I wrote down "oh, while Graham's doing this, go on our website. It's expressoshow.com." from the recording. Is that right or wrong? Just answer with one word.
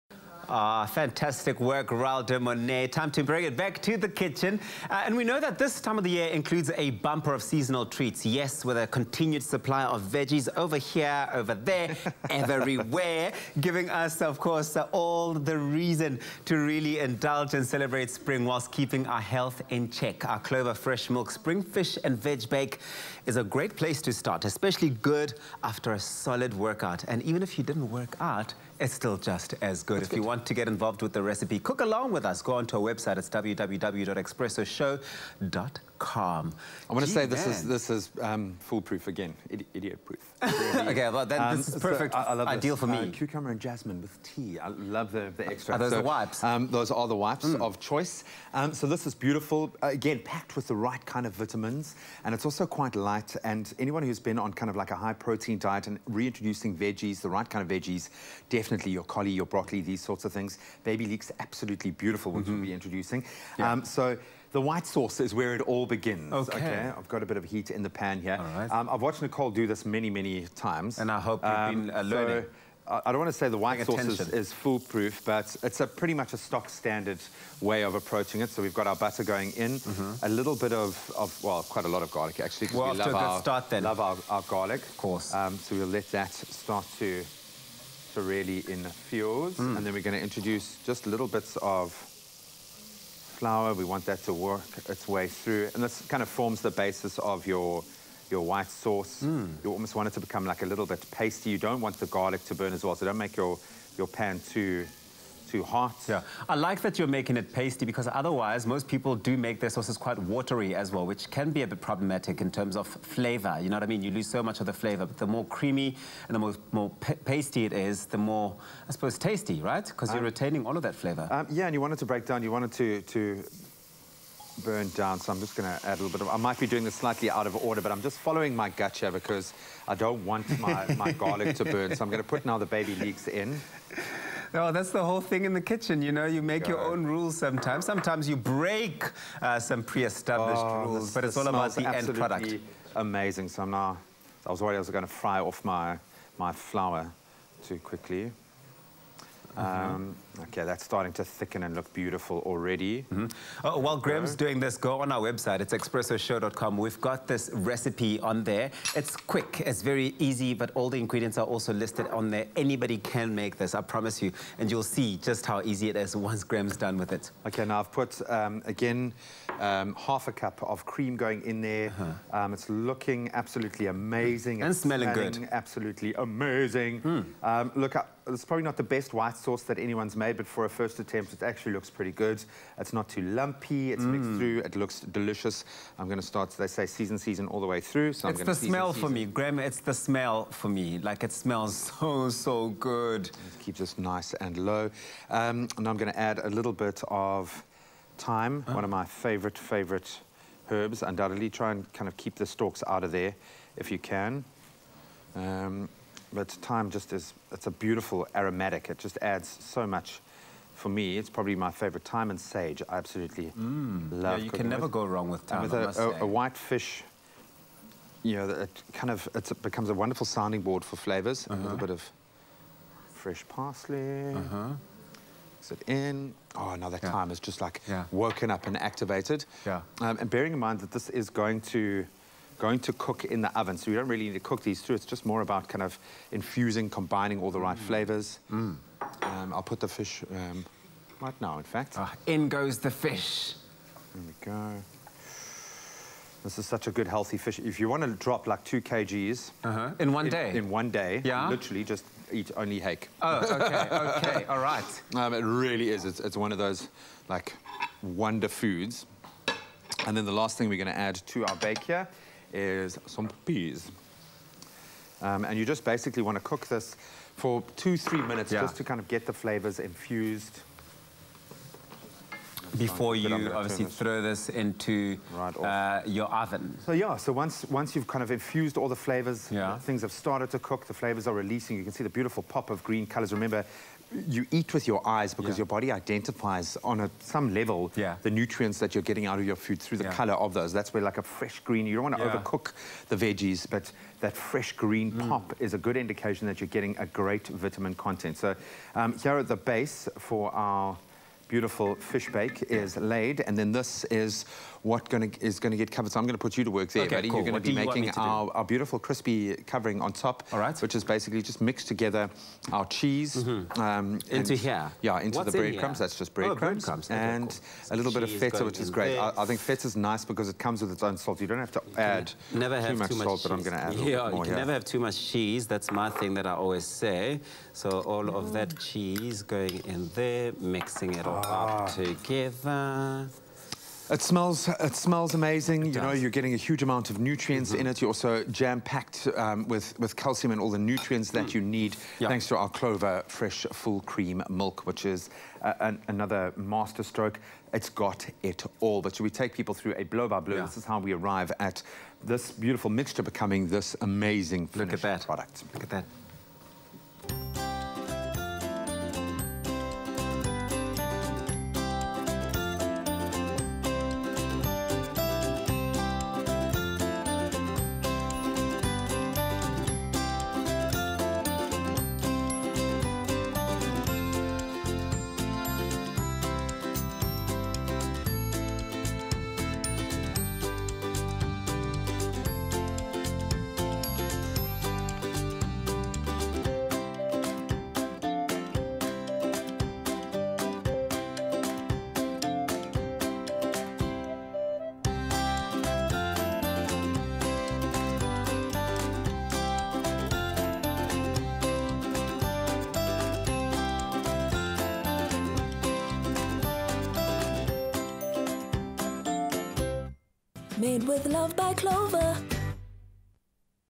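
right.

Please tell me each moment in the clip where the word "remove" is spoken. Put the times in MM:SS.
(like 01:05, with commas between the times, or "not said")
not said.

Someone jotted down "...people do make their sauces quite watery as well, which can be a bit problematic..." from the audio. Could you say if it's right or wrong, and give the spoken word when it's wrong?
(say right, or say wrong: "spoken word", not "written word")
right.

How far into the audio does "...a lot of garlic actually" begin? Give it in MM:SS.
01:21.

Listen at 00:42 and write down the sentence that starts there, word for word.
Uh, cucumber and jasmine with tea.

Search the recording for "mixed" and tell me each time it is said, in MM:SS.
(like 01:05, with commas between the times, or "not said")
03:04, 05:11.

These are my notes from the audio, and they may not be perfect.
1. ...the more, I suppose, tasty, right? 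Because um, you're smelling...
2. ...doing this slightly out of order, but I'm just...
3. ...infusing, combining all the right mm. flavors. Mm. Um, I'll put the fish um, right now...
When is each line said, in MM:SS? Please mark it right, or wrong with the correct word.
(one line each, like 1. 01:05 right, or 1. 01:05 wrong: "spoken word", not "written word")
1. 01:58 wrong: "retaining", not "smelling"
2. 02:06 right
3. 03:56 right.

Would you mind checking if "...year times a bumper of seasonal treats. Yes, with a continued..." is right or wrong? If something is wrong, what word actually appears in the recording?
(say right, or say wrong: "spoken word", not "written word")
wrong: "includes", not "times".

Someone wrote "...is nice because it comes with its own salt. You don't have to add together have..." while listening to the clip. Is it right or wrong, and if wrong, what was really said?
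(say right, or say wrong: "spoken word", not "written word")
wrong: "never", not "together".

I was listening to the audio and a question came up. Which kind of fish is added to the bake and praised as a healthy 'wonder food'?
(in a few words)
hake.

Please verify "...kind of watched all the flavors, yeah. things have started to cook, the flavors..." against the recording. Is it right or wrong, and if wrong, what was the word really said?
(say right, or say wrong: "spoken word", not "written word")
wrong: "infused", not "watched".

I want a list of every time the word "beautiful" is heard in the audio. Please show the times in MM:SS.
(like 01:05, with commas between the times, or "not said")
00:49, 01:02, 02:31, 03:27, 04:42, 05:01, 05:08, 05:52.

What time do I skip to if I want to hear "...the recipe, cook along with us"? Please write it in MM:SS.
00:31.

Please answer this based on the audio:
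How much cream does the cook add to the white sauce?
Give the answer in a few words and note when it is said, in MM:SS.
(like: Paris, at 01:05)
half a cup, at 02:50.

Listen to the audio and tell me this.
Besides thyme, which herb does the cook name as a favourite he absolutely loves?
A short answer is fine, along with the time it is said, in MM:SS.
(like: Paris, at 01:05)
sage, at 03:32.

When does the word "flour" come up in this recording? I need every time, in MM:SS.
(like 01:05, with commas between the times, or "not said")
01:33, 02:26.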